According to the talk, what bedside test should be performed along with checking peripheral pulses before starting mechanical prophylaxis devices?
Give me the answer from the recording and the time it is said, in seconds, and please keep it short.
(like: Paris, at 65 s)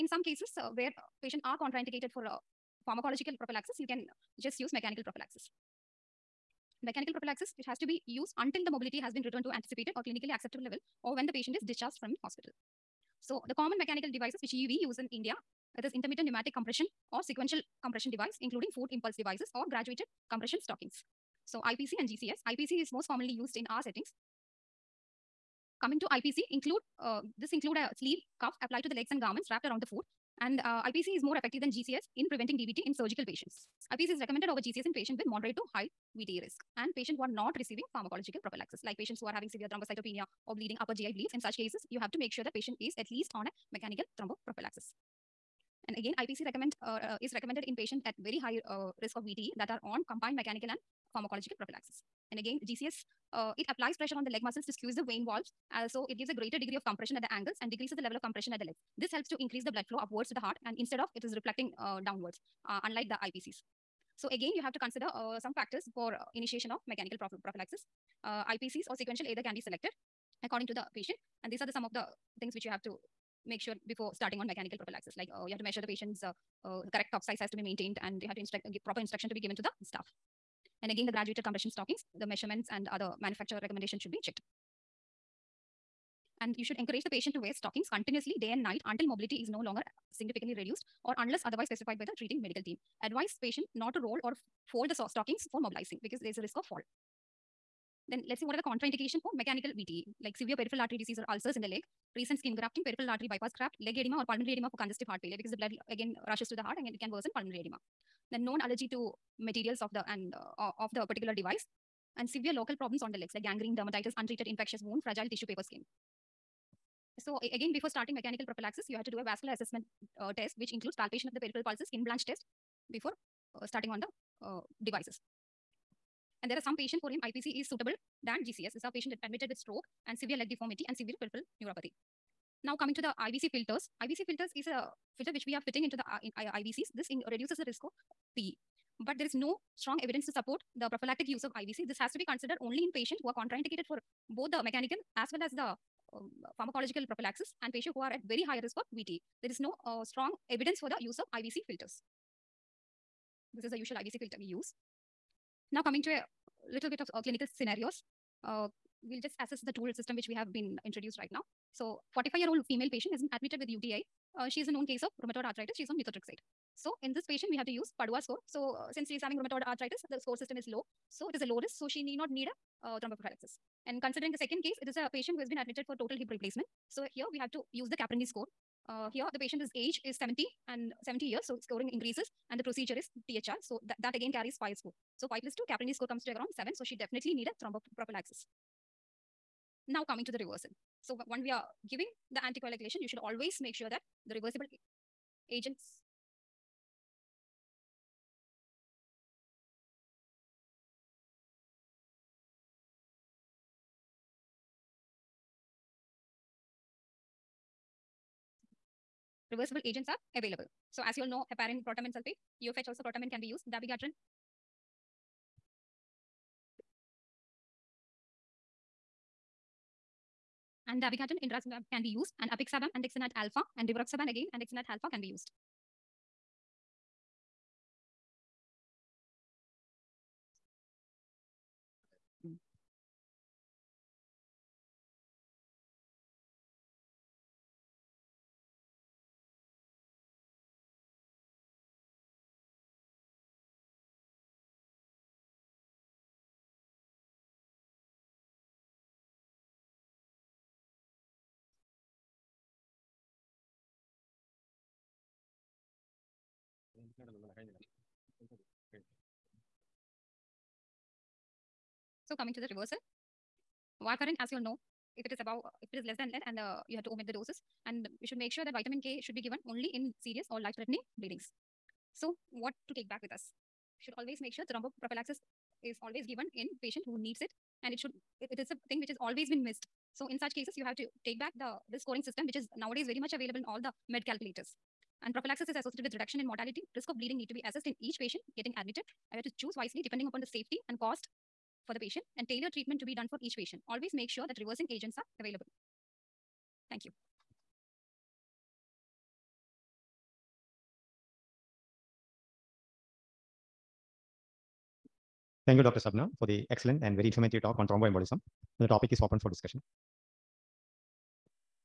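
Skin blanch test, at 121 s.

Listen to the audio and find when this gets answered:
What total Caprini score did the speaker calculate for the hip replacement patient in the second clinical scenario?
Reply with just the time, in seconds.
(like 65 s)
185 s.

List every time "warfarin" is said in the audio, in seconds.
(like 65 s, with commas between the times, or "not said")
264 s.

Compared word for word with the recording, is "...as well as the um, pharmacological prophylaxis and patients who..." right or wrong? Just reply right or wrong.
right.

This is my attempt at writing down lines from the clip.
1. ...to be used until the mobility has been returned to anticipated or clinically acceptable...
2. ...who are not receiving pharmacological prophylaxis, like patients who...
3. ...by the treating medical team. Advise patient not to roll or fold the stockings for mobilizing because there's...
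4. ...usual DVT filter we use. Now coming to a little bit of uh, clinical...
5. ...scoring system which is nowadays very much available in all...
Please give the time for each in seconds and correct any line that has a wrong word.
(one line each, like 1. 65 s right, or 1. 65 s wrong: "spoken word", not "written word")
1. 7 s right
2. 37 s right
3. 91 s right
4. 153 s wrong: "IVC", not "DVT"
5. 282 s right.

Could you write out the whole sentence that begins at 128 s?
These are patient admitted with stroke and severe leg deformity and severe peripheral neuropathy.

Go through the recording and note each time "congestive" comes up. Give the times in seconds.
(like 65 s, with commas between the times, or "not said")
104 s.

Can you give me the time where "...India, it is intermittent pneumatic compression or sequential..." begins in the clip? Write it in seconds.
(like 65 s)
15 s.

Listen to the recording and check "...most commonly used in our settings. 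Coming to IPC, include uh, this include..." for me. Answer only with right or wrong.
right.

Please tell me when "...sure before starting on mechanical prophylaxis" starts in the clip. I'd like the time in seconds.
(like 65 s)
73 s.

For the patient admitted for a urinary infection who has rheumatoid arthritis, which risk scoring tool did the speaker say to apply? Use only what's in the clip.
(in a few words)
Padua score.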